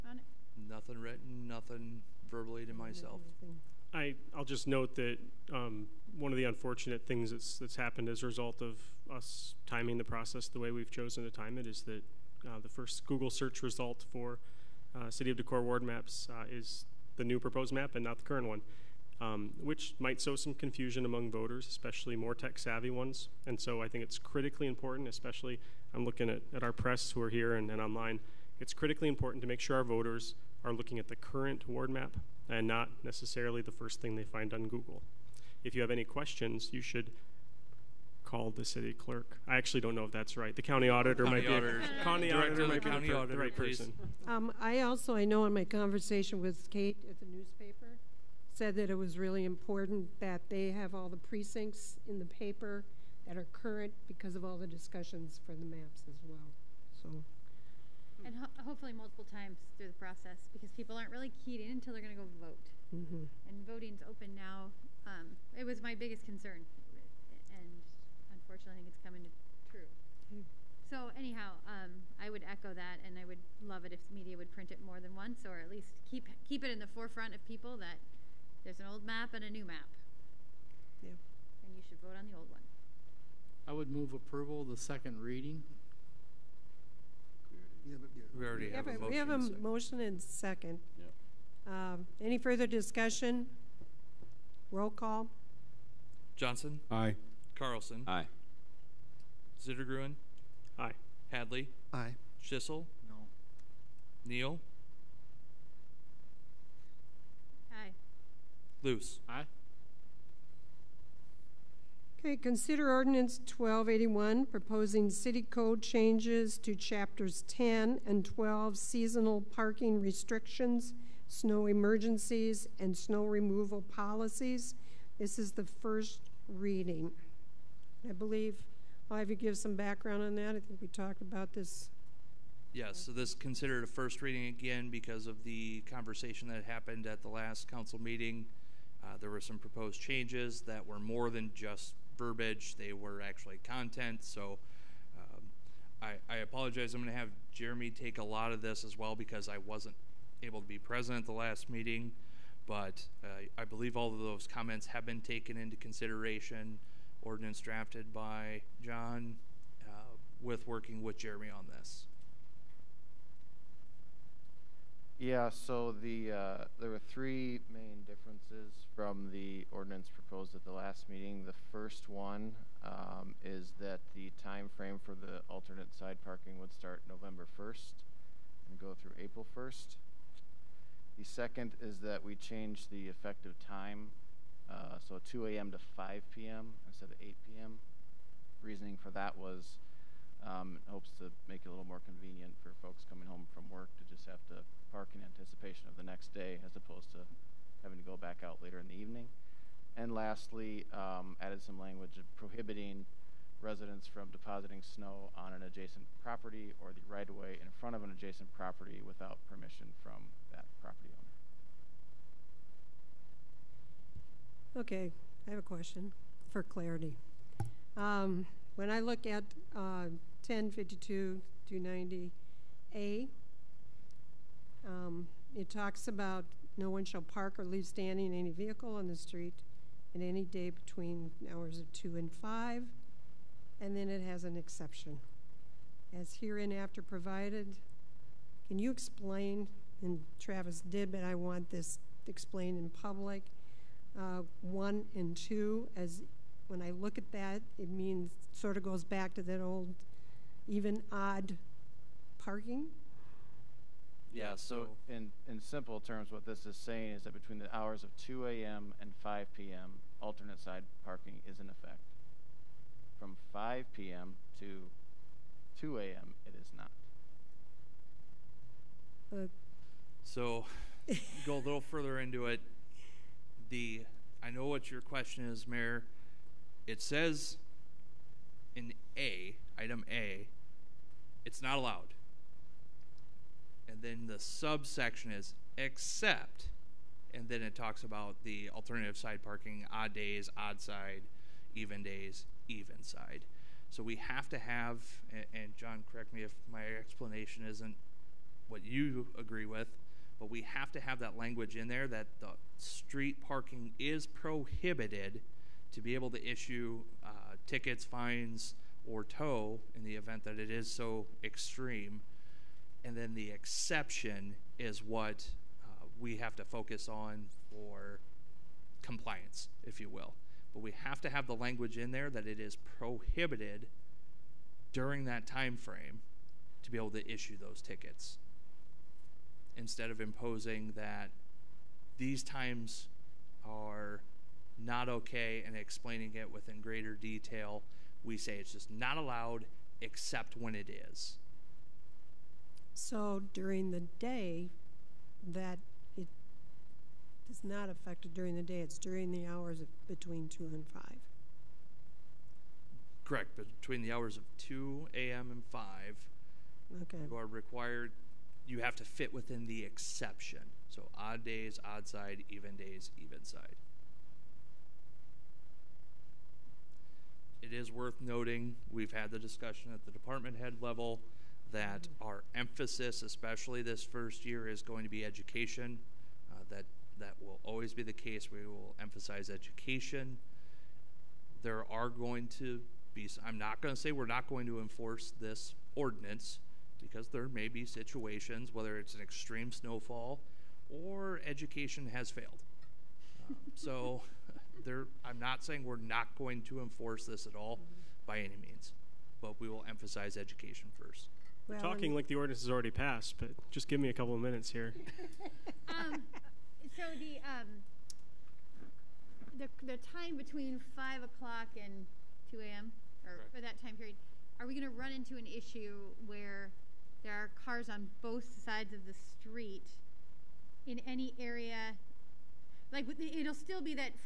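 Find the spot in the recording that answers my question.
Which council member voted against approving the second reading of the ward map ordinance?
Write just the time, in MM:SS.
01:42.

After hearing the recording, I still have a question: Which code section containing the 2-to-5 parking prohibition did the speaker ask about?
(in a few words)
1052 90 a.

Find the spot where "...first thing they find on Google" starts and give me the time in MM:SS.
00:33.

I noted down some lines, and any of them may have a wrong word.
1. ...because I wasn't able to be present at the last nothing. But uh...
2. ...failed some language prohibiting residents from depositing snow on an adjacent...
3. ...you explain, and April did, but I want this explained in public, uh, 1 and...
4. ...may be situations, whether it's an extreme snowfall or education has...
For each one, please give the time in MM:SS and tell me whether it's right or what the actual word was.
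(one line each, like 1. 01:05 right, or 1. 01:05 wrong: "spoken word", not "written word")
1. 02:29 wrong: "meeting", not "nothing"
2. 03:21 wrong: "added", not "failed"
3. 03:58 wrong: "Travis", not "April"
4. 06:27 right.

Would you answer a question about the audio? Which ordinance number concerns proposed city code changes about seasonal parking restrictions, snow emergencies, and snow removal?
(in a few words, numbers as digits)
1281.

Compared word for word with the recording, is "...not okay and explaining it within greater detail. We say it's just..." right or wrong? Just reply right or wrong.
right.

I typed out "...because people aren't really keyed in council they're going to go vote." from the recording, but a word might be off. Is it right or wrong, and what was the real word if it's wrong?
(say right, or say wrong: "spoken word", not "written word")
wrong: "until", not "council".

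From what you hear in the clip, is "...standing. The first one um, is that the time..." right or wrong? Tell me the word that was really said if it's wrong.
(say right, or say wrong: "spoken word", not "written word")
wrong: "meeting", not "standing".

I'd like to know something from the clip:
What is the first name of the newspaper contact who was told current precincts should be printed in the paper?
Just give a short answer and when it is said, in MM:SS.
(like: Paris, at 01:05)
Kate, at 00:46.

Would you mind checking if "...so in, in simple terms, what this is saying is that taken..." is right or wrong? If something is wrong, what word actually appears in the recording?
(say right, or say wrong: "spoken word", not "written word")
wrong: "between", not "taken".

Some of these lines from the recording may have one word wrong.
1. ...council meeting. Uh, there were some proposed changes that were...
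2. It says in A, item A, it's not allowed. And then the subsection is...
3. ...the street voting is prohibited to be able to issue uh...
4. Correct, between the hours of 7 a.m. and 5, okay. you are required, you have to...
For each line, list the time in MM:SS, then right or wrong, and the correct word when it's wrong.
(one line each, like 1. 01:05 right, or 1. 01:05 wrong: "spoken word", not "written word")
1. 02:17 right
2. 04:36 right
3. 05:02 wrong: "parking", not "voting"
4. 05:53 wrong: "2", not "7".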